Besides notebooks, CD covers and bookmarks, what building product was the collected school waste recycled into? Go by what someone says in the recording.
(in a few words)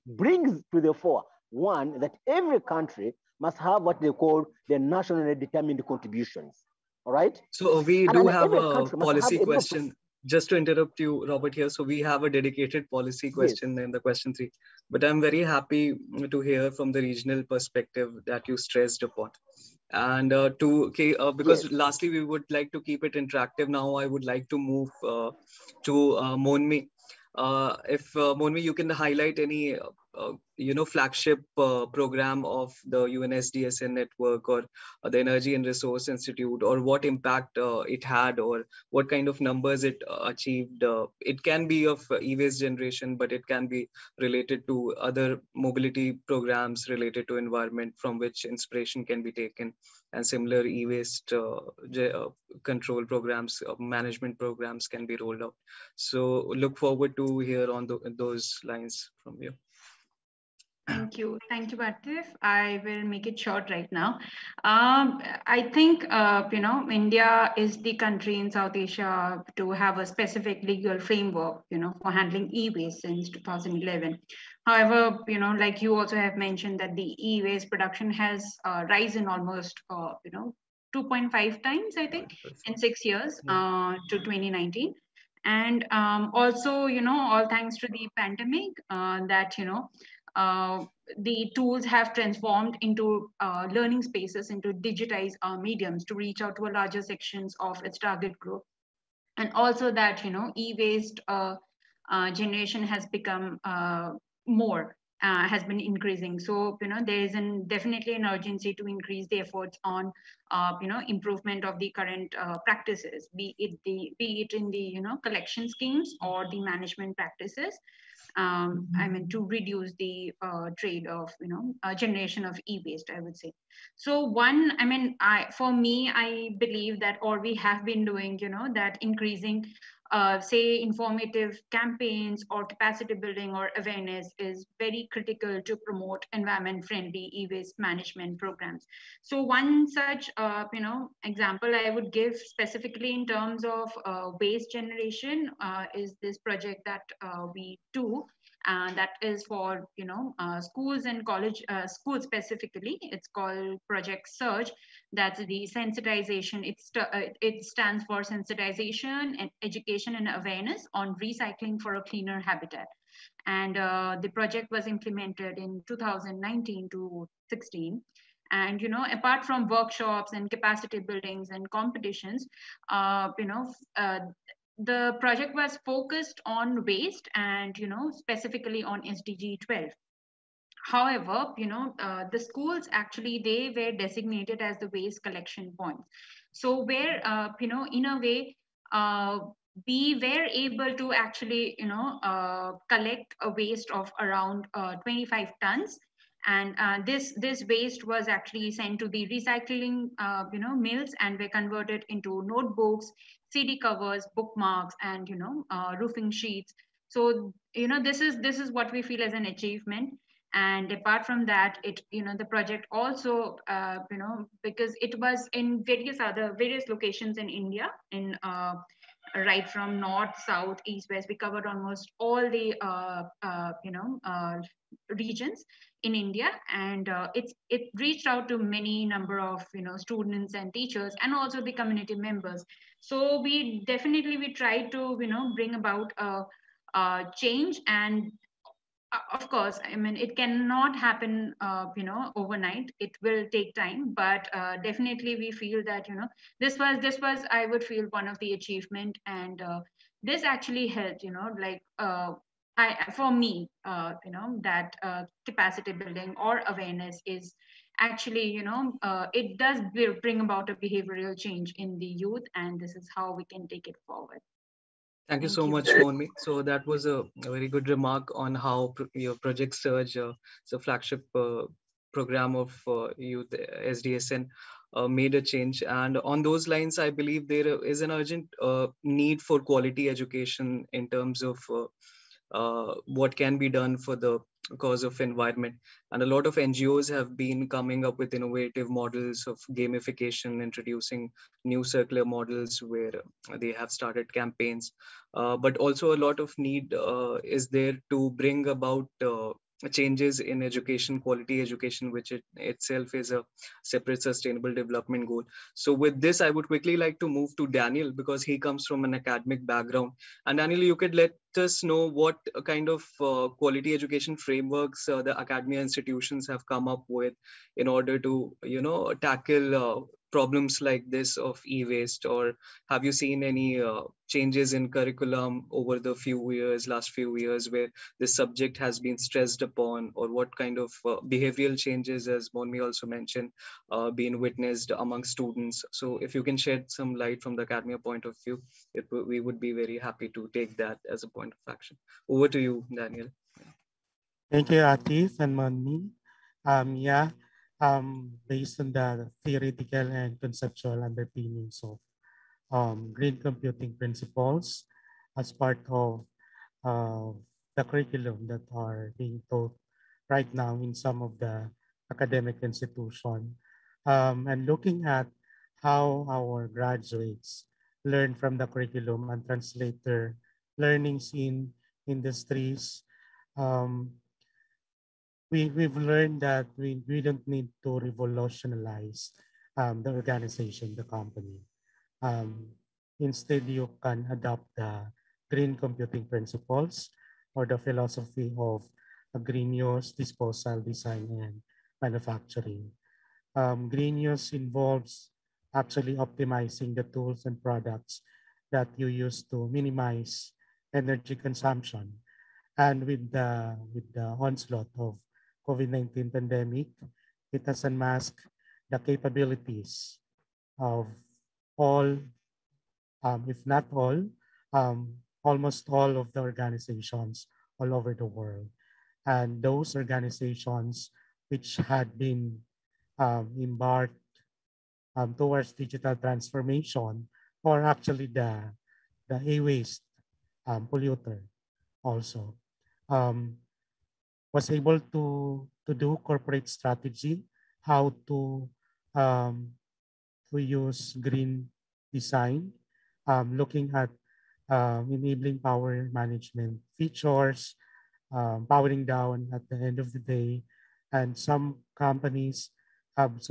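roofing sheets.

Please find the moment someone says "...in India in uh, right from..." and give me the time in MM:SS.
03:37.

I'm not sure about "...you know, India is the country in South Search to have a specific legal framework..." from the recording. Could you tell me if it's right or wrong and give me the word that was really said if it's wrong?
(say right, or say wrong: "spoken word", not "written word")
wrong: "Asia", not "Search".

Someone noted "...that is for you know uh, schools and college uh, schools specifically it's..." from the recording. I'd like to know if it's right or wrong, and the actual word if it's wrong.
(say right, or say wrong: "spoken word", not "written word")
right.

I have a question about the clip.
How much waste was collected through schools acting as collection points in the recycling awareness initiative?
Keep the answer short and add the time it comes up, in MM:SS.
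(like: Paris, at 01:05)
25 tons, at 03:14.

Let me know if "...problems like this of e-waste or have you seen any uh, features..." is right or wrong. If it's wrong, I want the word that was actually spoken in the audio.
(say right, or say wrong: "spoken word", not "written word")
wrong: "changes", not "features".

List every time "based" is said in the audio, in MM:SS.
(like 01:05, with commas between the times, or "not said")
05:48.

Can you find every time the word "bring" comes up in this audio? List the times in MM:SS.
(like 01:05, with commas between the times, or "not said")
00:00, 03:55, 04:20, 04:58.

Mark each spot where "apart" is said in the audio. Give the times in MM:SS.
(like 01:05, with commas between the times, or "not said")
02:49, 03:30.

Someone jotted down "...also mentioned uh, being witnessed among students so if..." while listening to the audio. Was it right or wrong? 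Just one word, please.
right.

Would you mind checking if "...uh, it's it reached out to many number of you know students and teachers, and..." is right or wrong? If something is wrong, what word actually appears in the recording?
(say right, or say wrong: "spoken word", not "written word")
right.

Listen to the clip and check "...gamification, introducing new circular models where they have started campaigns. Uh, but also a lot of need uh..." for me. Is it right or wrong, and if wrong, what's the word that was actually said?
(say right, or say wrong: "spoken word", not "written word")
right.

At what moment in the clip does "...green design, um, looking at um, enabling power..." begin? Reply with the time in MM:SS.
07:21.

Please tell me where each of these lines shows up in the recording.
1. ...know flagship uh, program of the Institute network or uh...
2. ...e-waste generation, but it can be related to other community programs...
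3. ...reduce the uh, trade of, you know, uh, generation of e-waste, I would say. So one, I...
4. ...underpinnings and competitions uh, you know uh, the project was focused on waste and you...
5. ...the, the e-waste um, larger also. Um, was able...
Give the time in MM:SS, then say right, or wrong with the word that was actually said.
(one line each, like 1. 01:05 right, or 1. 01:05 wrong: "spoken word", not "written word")
1. 00:30 wrong: "UNSDSN", not "Institute"
2. 00:42 wrong: "mobility", not "community"
3. 01:59 right
4. 02:50 wrong: "buildings", not "underpinnings"
5. 07:08 wrong: "polluter", not "larger".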